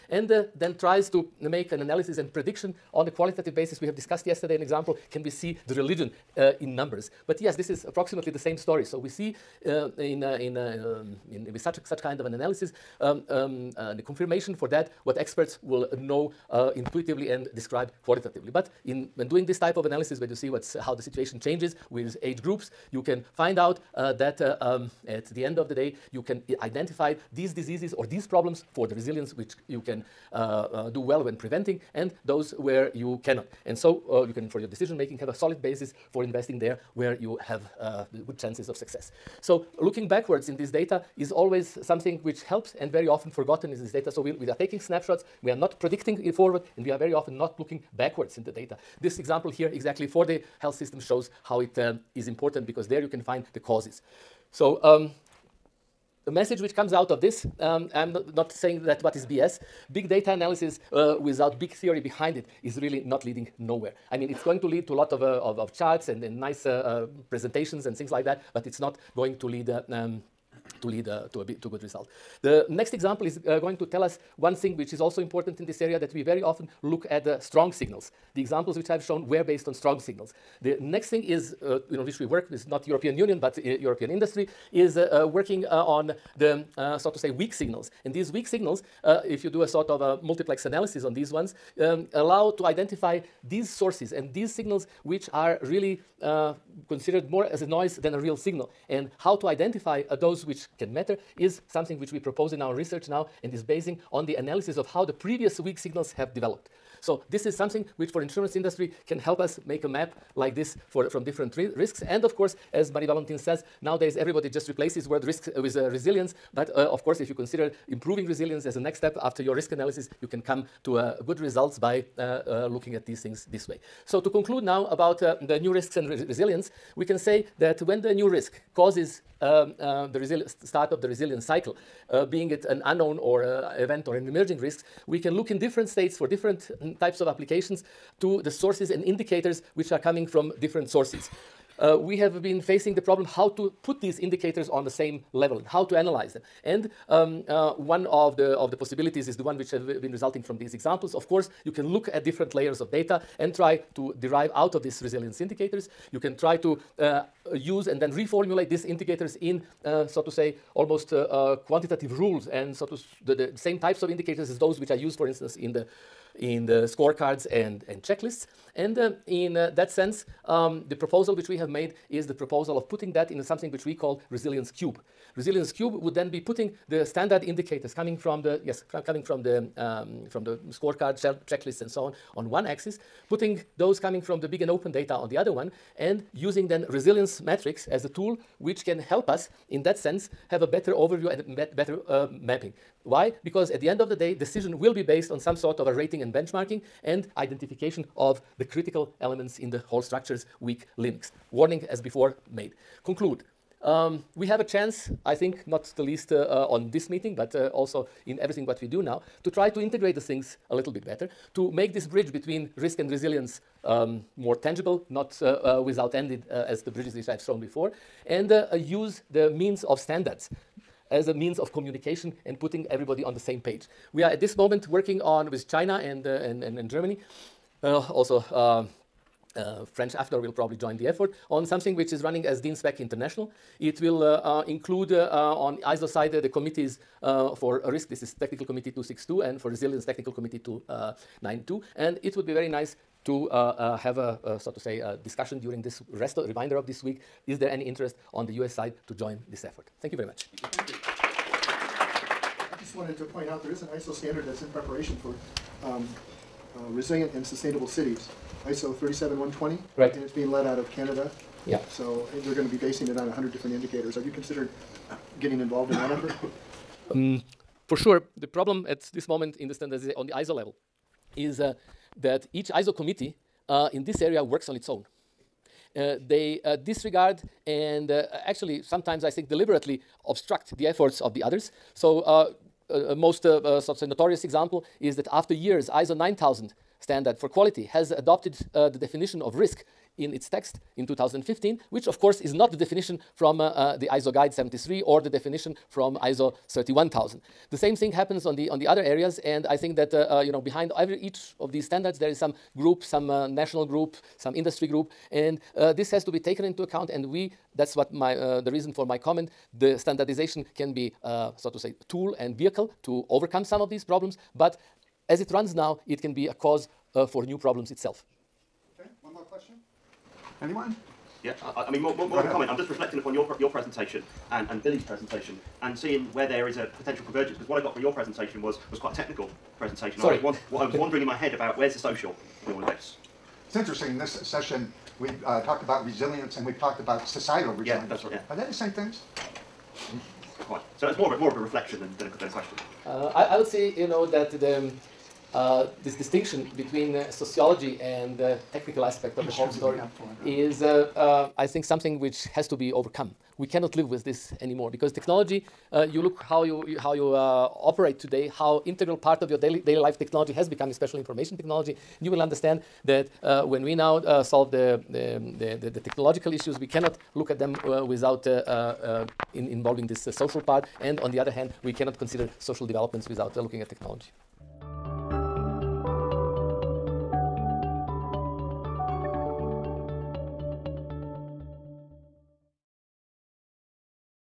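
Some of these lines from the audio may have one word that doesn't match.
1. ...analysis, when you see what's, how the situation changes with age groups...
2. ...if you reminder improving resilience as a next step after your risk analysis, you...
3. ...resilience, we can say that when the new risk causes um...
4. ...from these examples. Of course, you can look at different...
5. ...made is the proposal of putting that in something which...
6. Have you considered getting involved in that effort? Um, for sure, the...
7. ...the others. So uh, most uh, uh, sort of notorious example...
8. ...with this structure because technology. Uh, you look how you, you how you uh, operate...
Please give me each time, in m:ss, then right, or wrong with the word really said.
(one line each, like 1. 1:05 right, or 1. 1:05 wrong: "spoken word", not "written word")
1. 0:19 right
2. 1:57 wrong: "consider", not "reminder"
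3. 2:06 right
4. 2:30 right
5. 2:51 right
6. 4:24 right
7. 4:41 right
8. 5:54 wrong: "anymore", not "structure".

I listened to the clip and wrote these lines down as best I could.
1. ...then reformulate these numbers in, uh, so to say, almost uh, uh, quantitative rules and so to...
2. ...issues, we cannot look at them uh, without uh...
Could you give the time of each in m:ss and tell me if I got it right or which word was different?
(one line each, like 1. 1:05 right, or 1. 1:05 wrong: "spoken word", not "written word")
1. 2:38 wrong: "indicators", not "numbers"
2. 6:06 right.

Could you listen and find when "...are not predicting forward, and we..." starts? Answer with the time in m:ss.
0:45.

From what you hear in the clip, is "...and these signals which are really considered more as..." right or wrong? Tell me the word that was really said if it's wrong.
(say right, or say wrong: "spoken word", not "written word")
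right.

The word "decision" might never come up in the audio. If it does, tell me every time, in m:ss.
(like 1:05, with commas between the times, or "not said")
0:34, 3:14.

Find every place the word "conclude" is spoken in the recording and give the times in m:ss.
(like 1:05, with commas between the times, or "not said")
2:04, 3:23.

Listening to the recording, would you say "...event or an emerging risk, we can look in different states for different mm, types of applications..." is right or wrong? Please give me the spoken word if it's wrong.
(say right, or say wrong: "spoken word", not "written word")
right.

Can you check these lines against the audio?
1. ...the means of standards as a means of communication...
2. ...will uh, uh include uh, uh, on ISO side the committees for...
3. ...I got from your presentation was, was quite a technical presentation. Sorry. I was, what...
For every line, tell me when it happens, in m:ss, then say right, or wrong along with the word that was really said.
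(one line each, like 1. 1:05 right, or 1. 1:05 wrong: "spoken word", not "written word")
1. 3:39 right
2. 3:54 right
3. 5:27 right.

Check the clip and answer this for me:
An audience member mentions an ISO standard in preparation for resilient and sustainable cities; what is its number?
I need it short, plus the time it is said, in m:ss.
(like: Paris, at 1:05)
ISO 37120, at 4:18.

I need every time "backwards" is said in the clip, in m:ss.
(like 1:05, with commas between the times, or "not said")
0:40, 0:47.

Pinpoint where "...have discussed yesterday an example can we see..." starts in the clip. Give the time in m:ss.
0:03.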